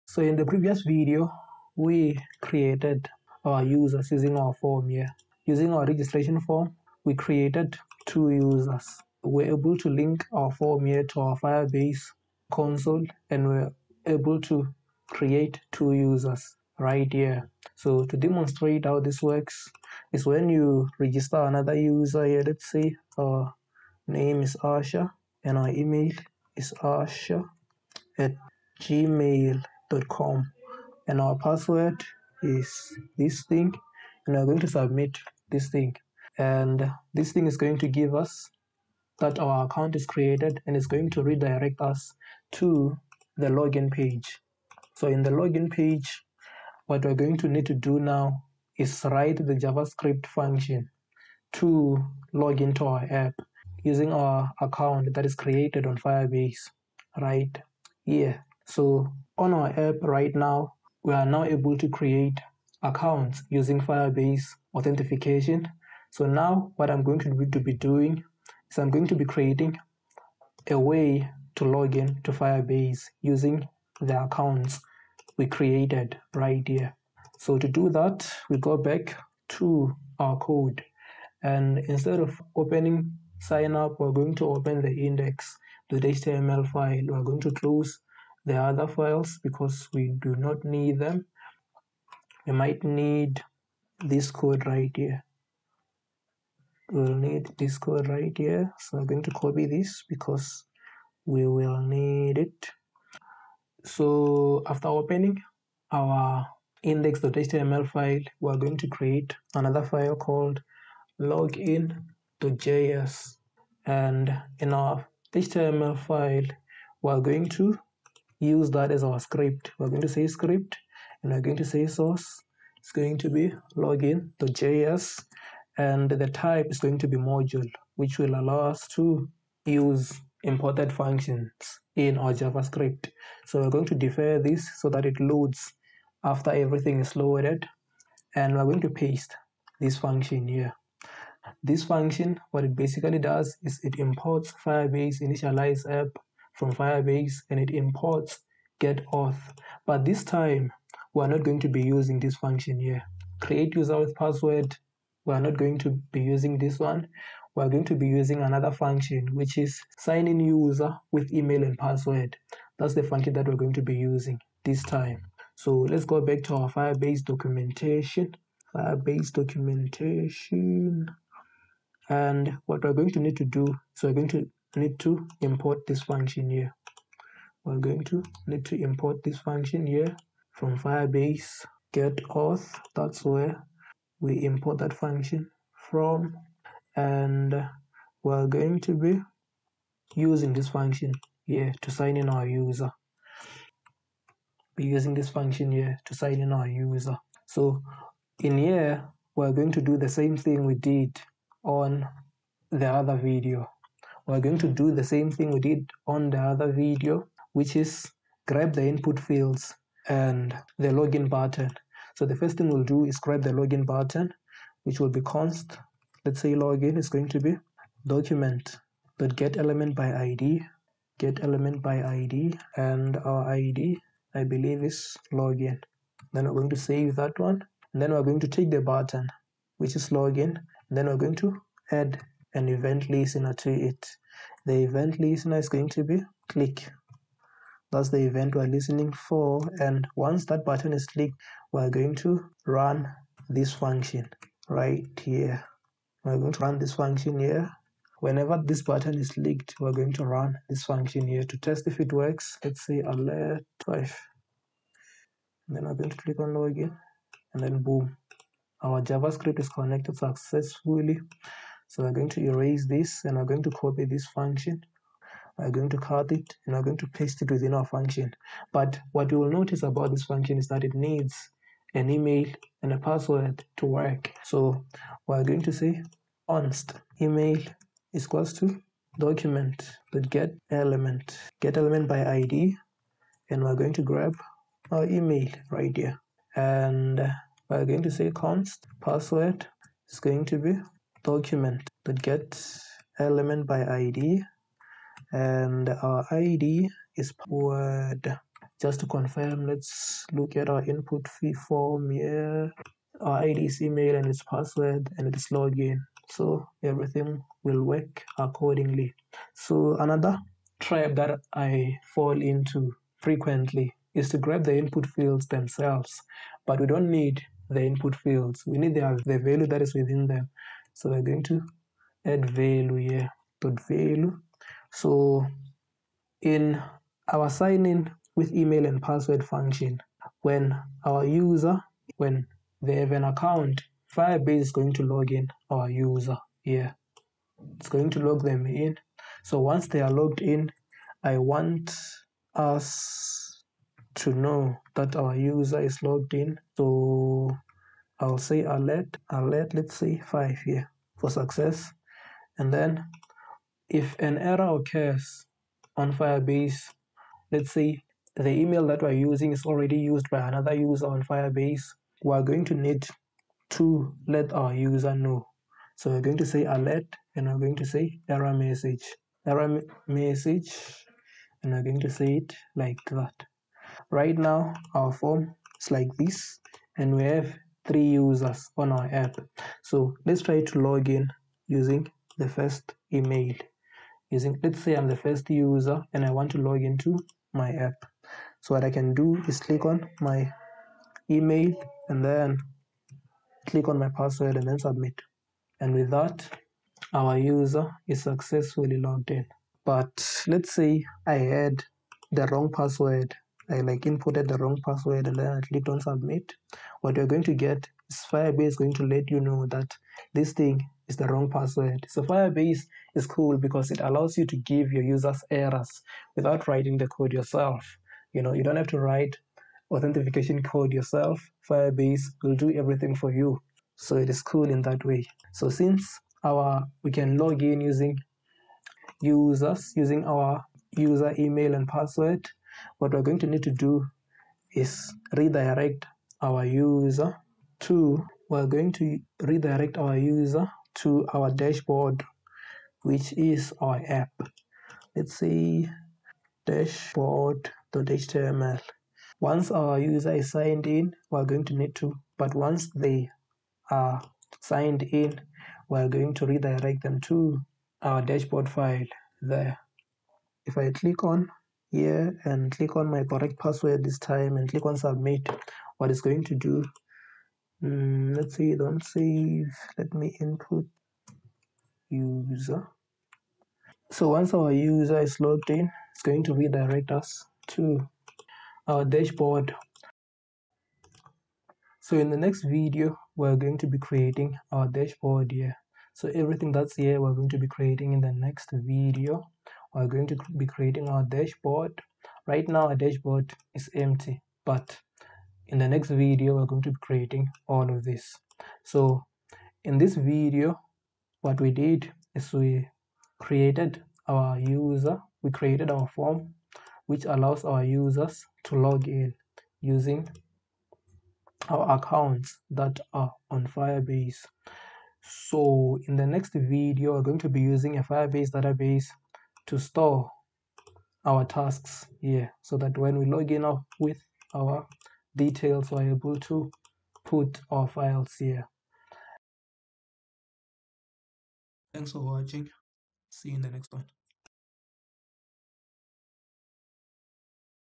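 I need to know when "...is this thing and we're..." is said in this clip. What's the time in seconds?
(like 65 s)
32 s.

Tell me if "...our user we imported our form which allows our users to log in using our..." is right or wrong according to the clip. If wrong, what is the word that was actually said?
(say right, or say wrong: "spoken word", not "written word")
wrong: "created", not "imported".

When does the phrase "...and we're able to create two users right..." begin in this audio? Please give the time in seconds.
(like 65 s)
13 s.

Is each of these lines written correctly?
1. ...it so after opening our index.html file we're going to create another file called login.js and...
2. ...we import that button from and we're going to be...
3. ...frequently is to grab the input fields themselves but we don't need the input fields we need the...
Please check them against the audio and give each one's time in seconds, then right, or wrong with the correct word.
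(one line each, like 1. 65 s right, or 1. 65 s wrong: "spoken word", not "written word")
1. 102 s right
2. 184 s wrong: "function", not "button"
3. 313 s right.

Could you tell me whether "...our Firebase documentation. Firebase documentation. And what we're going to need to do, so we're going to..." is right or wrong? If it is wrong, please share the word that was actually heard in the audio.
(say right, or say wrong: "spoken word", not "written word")
right.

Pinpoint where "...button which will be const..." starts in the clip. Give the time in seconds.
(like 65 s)
213 s.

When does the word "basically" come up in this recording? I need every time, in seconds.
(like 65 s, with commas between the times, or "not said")
142 s.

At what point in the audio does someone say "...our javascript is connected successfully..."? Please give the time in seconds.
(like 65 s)
258 s.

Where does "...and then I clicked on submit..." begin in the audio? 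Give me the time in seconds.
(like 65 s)
405 s.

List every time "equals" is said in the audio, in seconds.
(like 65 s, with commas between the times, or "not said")
278 s.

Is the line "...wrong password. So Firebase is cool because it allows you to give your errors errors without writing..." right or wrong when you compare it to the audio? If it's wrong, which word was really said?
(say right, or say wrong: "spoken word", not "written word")
wrong: "users", not "errors".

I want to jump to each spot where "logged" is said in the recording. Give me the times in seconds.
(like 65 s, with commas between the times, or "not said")
340 s, 346 s, 398 s, 475 s.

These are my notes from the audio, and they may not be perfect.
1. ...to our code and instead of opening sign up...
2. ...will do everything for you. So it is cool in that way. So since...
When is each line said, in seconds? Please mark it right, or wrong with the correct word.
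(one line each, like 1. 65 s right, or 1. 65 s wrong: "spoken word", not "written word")
1. 79 s right
2. 422 s right.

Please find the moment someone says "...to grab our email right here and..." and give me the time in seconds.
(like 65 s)
283 s.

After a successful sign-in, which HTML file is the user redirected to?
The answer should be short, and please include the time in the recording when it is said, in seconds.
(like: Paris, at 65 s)
dashboard.html, at 446 s.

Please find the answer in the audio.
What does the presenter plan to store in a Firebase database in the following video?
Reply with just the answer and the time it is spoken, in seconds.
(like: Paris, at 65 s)
tasks, at 521 s.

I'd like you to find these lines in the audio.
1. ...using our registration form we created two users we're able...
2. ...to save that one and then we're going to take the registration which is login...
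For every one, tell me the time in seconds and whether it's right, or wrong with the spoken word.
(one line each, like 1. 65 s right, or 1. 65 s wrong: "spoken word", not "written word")
1. 5 s right
2. 226 s wrong: "button", not "registration".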